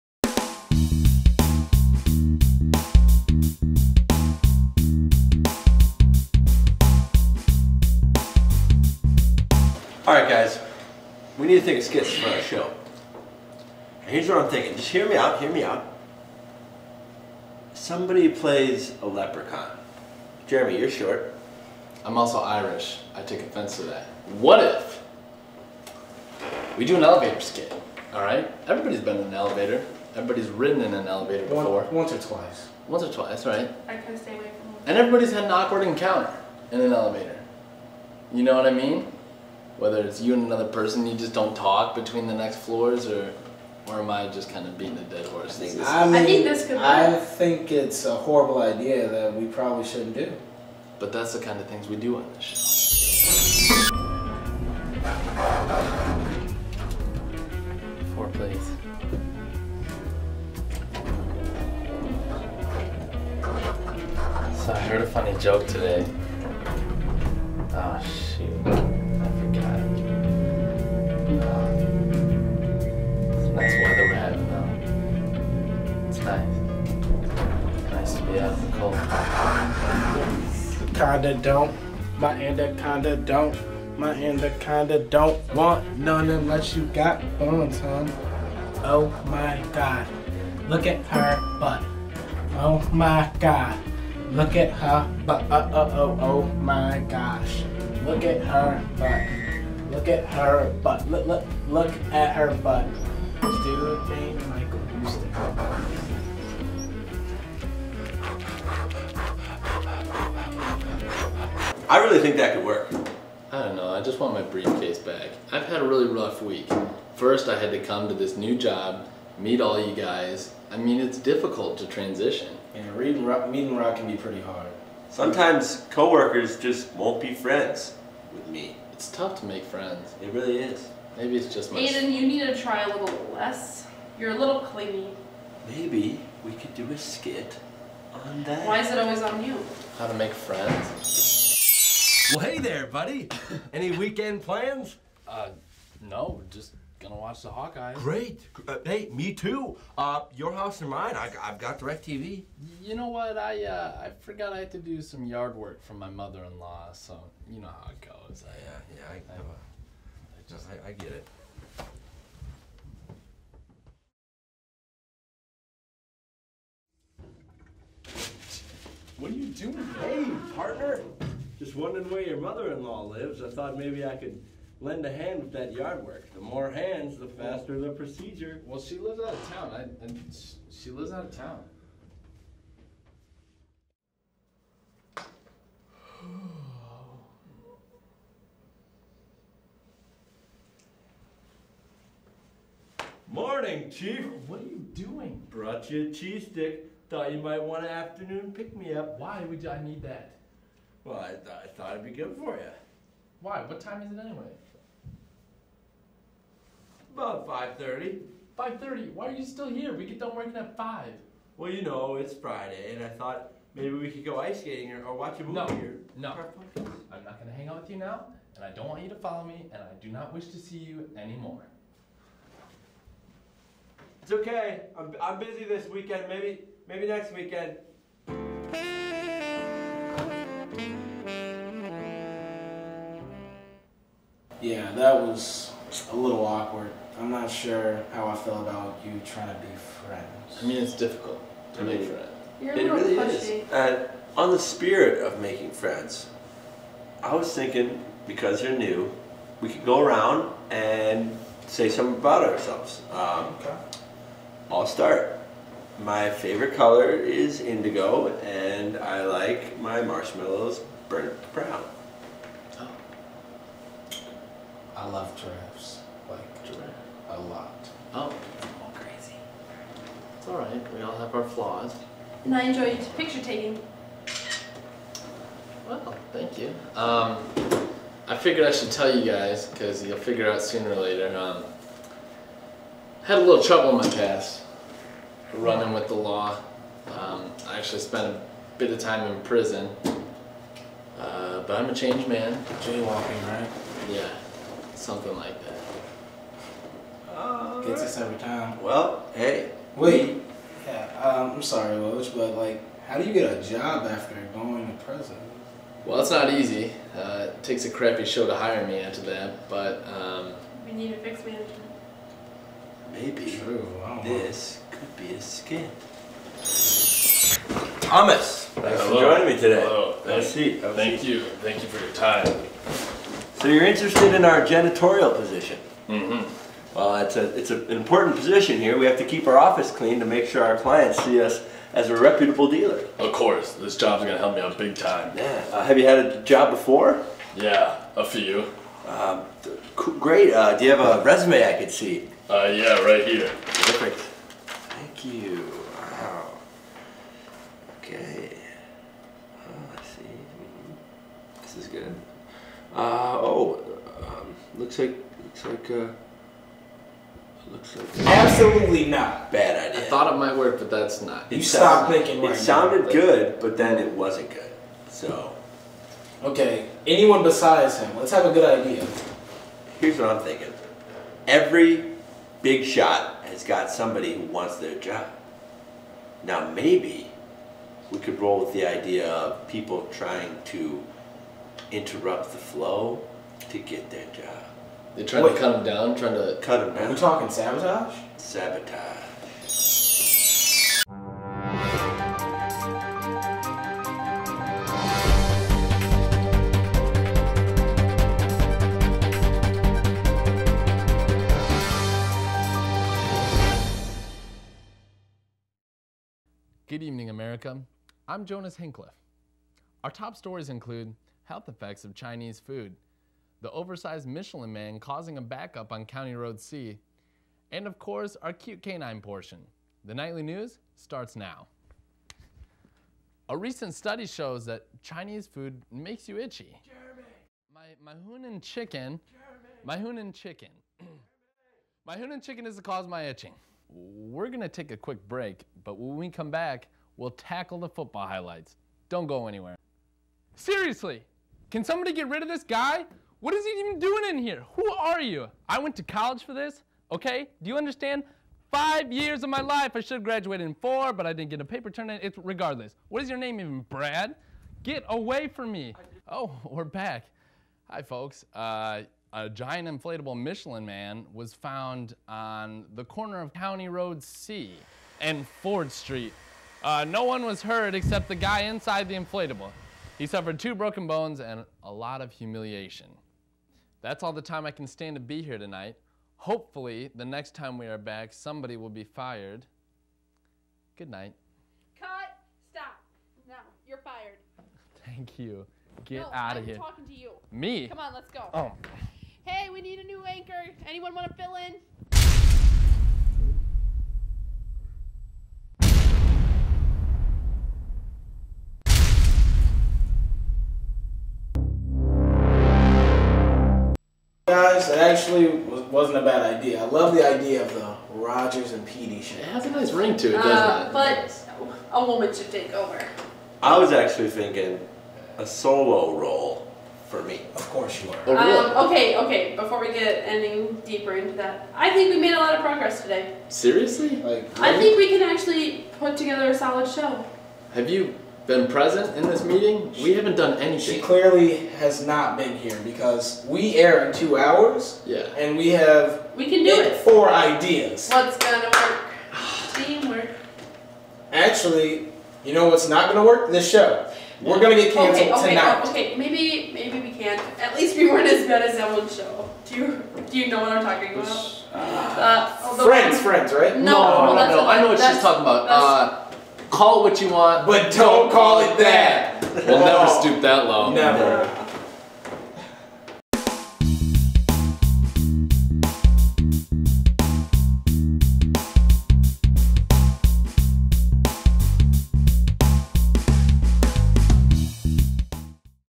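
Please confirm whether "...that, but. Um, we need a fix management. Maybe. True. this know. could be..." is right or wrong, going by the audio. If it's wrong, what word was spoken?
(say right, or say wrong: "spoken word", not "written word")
right.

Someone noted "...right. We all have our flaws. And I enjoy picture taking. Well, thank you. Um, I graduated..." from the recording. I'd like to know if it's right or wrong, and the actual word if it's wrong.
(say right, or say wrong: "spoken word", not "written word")
wrong: "figured", not "graduated".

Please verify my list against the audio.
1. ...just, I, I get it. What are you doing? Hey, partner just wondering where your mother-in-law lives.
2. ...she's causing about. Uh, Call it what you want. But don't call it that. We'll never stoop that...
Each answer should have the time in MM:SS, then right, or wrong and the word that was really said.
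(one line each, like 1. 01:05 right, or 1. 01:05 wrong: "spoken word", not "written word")
1. 02:40 right
2. 09:14 wrong: "talking", not "causing".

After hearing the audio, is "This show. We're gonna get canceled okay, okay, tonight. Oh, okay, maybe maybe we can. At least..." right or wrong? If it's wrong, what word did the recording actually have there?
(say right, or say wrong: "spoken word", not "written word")
right.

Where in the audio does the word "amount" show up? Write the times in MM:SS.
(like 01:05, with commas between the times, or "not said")
not said.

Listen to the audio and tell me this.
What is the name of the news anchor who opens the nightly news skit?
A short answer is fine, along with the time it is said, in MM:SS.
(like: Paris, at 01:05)
Jonas Hincliffe, at 06:48.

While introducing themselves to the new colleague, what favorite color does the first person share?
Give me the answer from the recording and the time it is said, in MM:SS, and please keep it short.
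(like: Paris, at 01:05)
Indigo, at 04:17.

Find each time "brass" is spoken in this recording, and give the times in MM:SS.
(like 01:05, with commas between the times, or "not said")
not said.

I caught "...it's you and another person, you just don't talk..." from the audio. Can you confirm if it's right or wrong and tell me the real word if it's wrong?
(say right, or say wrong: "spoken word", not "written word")
right.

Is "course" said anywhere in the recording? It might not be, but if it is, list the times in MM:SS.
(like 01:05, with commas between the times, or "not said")
05:33, 06:57, 08:37.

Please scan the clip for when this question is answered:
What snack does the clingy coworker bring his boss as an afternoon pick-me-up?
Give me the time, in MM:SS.
03:16.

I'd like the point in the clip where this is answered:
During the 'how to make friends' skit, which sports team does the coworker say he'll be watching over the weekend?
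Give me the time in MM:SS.
02:27.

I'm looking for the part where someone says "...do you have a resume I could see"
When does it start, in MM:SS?
05:40.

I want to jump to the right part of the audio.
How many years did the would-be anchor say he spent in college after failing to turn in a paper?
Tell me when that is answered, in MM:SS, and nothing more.
07:28.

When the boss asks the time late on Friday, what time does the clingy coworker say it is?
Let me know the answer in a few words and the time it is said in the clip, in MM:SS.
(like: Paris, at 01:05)
5:30, at 03:27.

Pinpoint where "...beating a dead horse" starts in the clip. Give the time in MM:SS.
00:44.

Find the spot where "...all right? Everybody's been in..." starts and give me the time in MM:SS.
00:28.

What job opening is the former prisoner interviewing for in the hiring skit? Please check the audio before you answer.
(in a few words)
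Janitorial position.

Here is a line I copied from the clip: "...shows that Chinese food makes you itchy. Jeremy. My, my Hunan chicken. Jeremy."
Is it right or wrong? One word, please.
right.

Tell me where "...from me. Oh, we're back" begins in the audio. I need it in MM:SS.
07:35.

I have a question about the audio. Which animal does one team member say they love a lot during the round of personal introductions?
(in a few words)
Giraffes.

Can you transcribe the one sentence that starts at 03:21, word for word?
Well, I, th I thought it'd be good for you.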